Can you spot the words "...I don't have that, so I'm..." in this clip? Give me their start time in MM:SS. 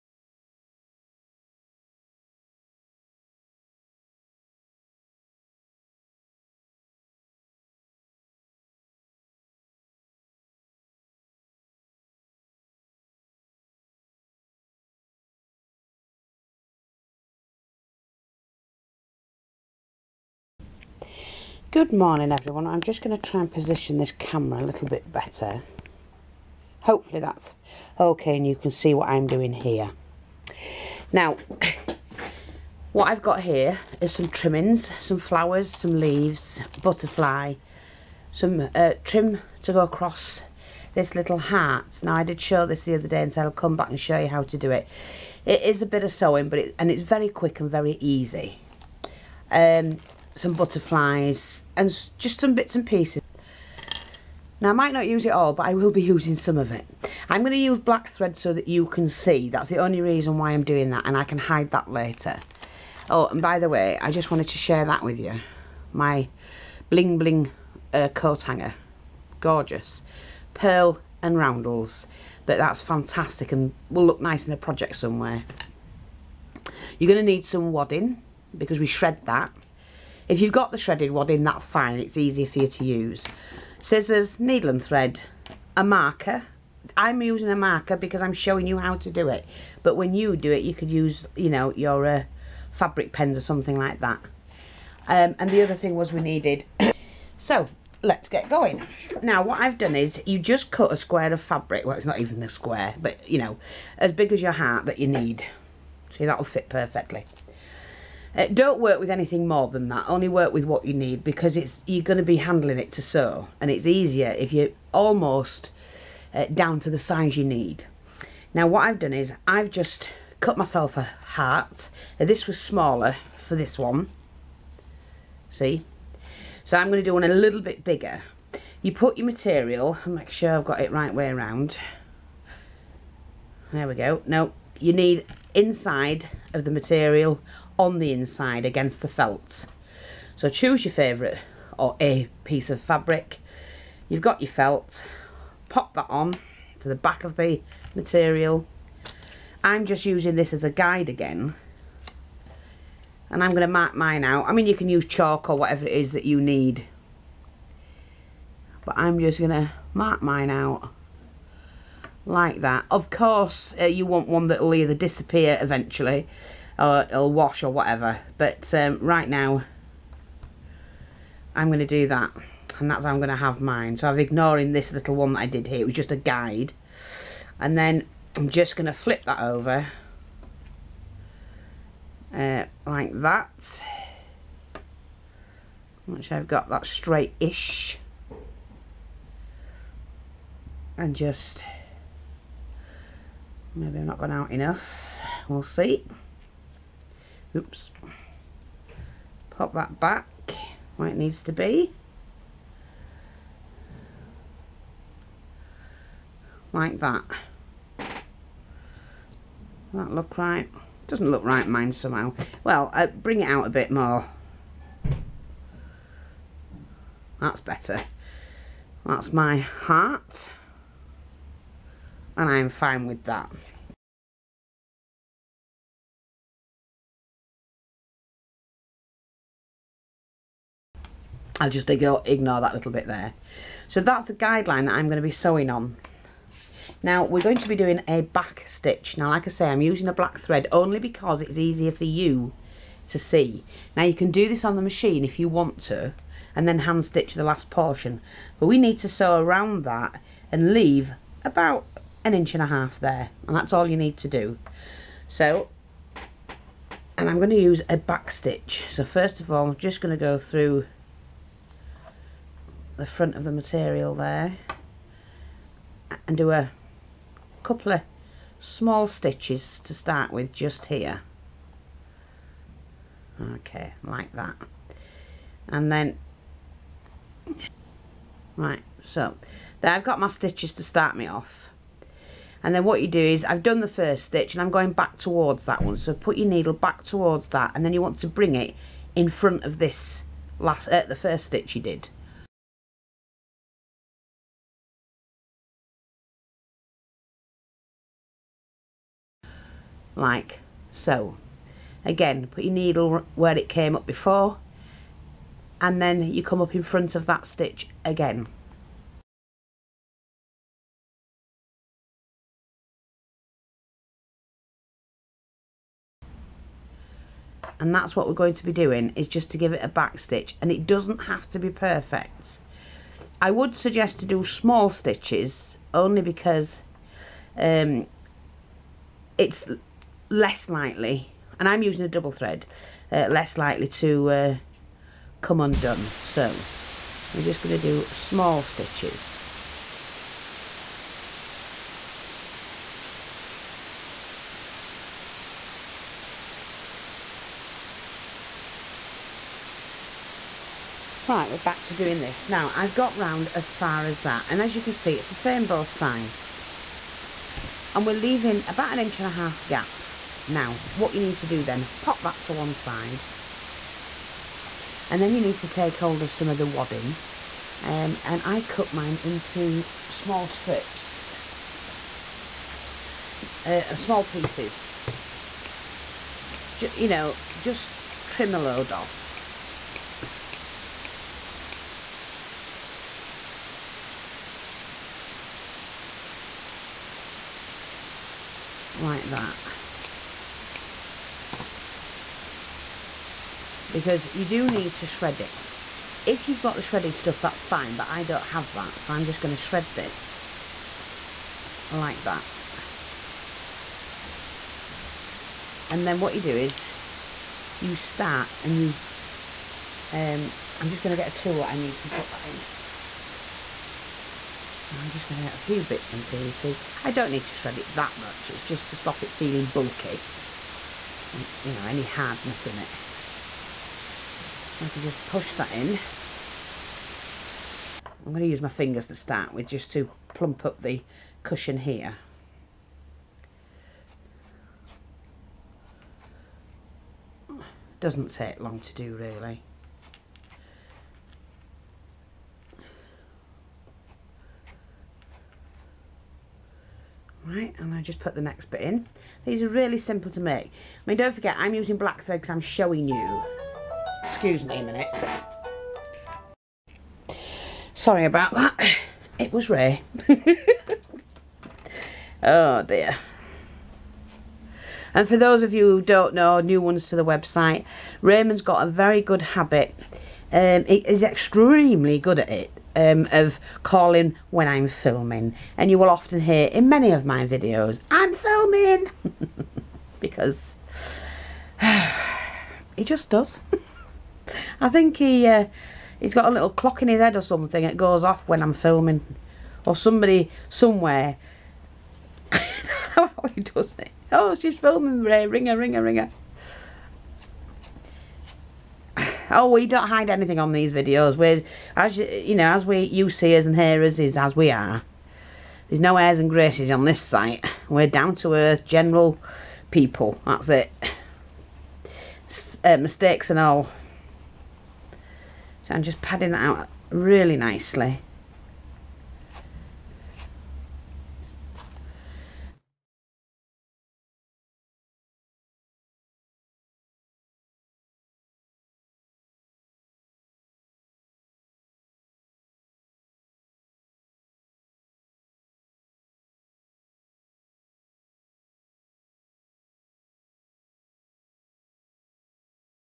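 06:38.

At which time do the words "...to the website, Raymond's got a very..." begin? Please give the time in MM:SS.
07:47.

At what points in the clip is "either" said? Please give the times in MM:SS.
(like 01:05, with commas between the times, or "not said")
02:44.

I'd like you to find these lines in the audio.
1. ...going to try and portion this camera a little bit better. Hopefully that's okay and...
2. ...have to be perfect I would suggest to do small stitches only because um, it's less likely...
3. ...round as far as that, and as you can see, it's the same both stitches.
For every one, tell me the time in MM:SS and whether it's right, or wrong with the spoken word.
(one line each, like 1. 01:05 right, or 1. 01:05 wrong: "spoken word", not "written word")
1. 00:23 wrong: "position", not "portion"
2. 05:21 right
3. 05:53 wrong: "sides", not "stitches".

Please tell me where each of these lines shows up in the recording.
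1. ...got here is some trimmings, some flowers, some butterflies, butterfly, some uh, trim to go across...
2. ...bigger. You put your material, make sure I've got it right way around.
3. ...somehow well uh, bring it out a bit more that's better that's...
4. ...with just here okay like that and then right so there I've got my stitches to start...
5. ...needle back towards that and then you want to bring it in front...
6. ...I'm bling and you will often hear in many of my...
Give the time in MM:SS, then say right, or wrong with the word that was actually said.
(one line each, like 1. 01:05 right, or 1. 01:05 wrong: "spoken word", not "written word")
1. 00:33 wrong: "leaves", not "butterflies"
2. 02:07 right
3. 03:31 right
4. 04:30 right
5. 04:46 right
6. 07:54 wrong: "filming", not "bling".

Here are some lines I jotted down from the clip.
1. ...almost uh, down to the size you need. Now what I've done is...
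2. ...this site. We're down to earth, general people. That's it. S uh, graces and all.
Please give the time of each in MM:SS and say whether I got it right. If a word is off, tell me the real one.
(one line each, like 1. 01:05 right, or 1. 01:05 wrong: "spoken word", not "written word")
1. 01:54 right
2. 08:27 wrong: "mistakes", not "graces".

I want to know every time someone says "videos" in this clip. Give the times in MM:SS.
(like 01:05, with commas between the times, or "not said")
07:57, 08:20.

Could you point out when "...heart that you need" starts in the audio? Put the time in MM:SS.
01:44.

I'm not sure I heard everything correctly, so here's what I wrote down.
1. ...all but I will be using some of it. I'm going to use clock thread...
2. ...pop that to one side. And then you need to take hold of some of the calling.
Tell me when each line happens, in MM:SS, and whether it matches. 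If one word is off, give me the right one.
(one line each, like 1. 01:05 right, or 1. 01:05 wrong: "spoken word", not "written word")
1. 00:55 wrong: "black", not "clock"
2. 06:02 wrong: "wadding", not "calling".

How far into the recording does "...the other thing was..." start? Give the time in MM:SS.
01:35.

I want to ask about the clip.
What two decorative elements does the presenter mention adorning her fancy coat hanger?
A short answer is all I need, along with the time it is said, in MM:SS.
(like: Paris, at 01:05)
Pearl and roundels, at 01:10.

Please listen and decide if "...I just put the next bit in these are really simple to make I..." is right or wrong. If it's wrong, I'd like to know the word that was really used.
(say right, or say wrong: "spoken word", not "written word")
right.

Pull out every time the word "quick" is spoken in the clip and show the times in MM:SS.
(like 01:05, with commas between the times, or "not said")
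00:47.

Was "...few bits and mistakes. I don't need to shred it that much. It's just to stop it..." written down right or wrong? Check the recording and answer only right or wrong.
wrong.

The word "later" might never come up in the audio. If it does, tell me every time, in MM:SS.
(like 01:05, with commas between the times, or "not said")
01:01.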